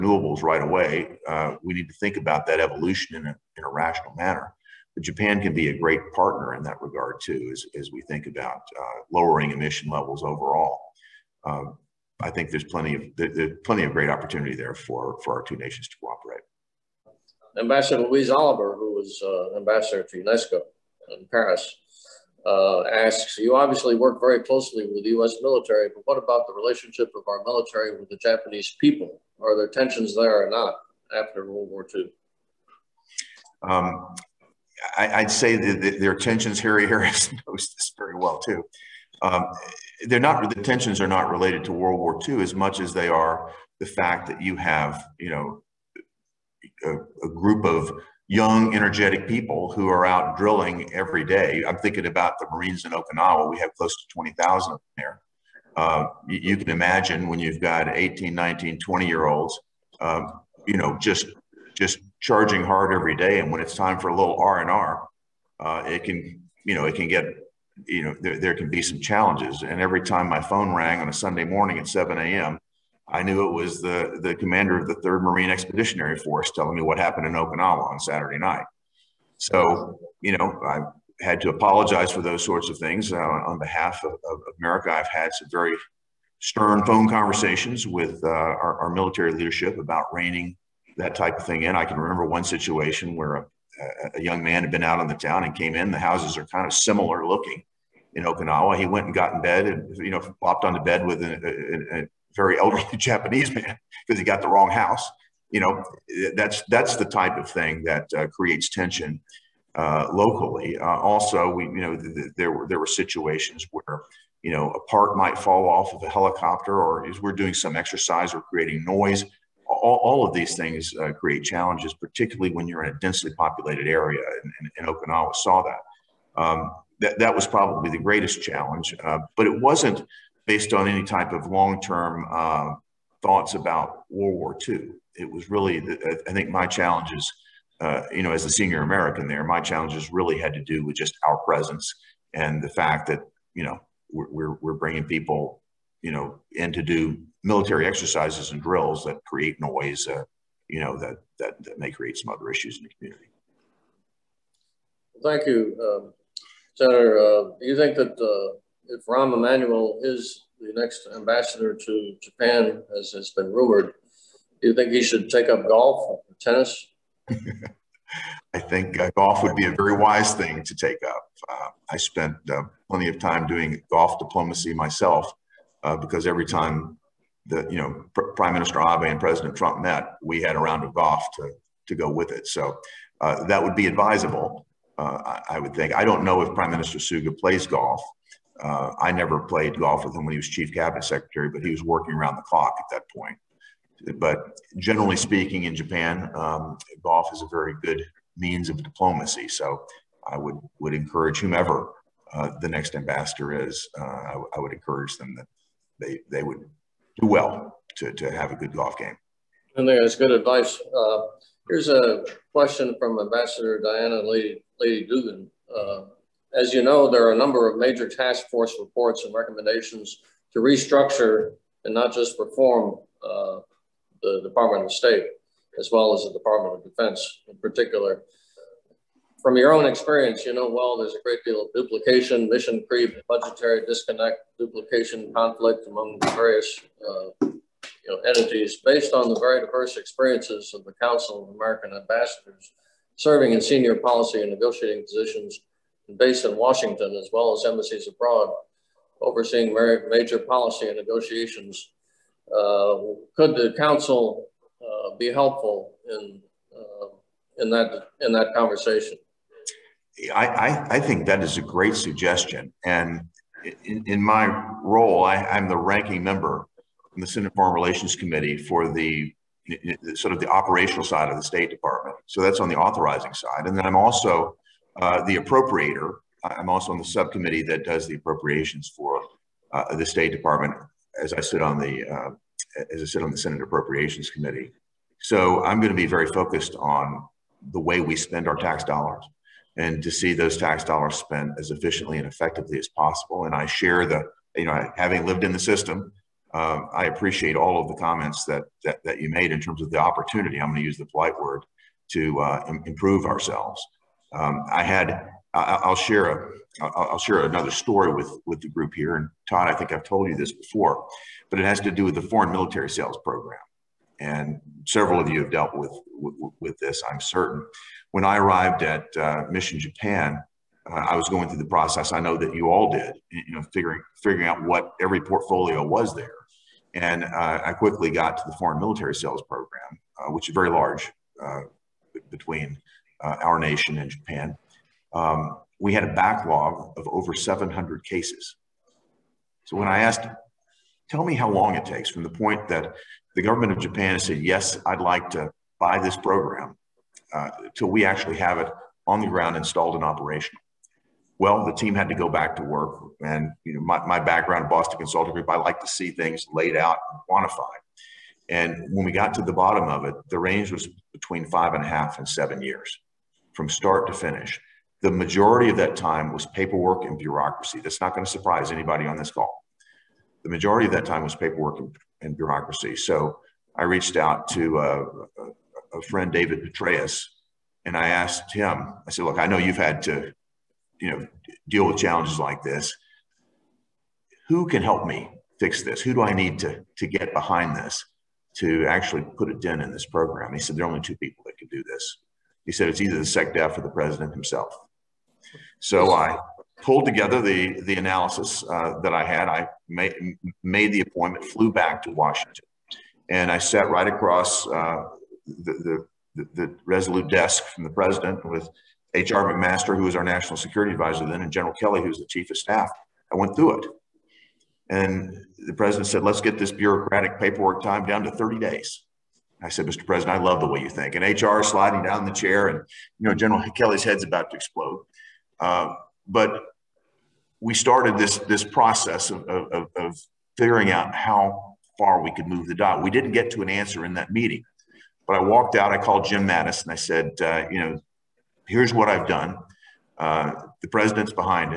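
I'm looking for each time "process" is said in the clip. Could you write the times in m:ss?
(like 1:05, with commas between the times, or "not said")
5:21, 7:08.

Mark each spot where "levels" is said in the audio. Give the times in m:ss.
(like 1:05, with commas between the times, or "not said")
0:09.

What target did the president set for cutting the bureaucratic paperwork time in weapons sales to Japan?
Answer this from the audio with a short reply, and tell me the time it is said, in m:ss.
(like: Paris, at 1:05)
30 days, at 6:58.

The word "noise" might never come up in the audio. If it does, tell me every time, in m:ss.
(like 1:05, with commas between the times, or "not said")
1:58, 2:29.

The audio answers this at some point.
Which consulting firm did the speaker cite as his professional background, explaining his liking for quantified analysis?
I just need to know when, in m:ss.
5:54.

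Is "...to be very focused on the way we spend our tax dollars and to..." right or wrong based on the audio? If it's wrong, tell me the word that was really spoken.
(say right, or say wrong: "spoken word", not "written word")
right.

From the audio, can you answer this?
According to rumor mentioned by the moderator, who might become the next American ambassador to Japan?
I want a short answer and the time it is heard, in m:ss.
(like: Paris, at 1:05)
Rahm Emanuel, at 2:39.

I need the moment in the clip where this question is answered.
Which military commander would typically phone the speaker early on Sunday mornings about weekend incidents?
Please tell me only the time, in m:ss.
1:14.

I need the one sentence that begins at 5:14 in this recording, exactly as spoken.
And several of you have dealt with, with, with this, I'm certain.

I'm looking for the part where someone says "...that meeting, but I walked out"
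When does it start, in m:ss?
7:14.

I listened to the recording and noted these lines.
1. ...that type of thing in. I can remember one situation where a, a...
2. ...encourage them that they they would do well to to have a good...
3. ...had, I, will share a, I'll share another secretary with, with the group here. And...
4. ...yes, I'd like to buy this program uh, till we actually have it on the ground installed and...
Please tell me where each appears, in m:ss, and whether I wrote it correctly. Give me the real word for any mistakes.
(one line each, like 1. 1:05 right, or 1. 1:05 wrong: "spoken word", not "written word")
1. 1:30 right
2. 3:24 right
3. 5:04 wrong: "story", not "secretary"
4. 5:44 right.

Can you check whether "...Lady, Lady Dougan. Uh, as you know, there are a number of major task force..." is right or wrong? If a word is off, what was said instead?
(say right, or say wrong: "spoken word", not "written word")
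right.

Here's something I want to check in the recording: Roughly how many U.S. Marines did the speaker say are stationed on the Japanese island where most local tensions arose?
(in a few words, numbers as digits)
20,000.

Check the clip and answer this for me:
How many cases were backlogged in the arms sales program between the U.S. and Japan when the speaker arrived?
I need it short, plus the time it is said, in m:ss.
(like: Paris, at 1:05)
over 700, at 5:37.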